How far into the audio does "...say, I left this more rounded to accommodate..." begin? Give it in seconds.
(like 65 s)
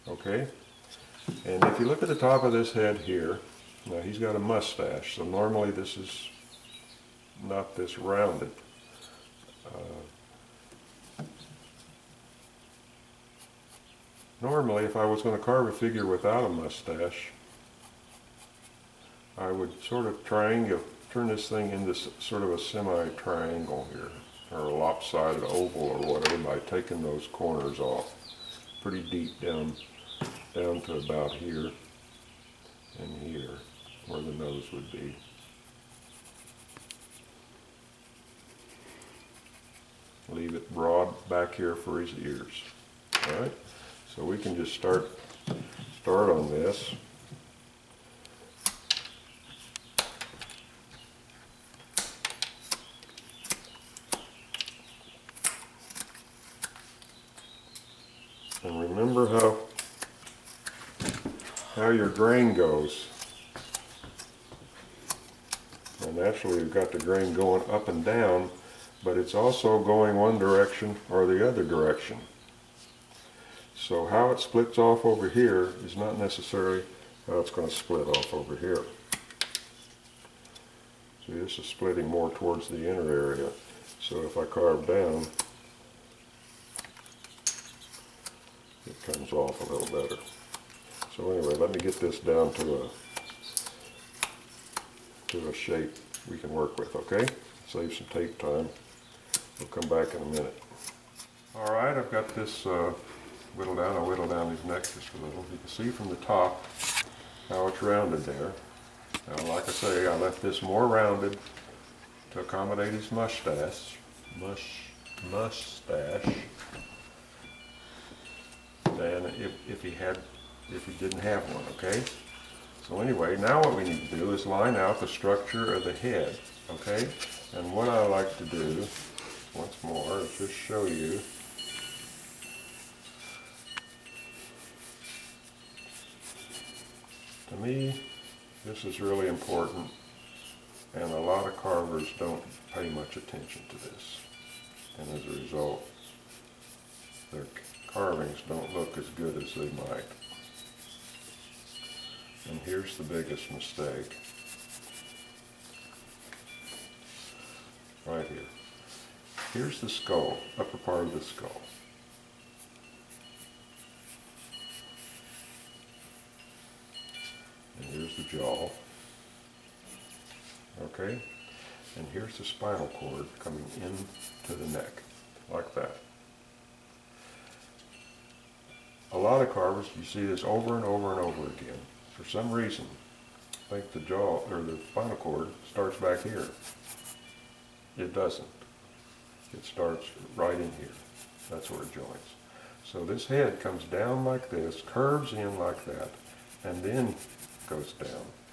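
109 s.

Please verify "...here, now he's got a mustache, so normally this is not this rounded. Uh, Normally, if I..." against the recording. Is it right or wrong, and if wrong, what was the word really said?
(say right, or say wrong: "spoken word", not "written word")
right.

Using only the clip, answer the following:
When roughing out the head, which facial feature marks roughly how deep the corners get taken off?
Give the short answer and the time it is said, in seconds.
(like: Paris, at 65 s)
Nose, at 34 s.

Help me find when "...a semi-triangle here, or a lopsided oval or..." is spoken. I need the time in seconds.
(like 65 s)
22 s.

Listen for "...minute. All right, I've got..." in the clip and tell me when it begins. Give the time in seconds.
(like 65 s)
100 s.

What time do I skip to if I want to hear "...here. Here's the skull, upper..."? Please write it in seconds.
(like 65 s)
158 s.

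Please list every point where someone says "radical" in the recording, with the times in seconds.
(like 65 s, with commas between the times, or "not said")
not said.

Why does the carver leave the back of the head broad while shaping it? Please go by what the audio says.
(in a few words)
For his ears.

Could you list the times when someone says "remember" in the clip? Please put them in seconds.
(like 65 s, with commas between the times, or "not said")
58 s.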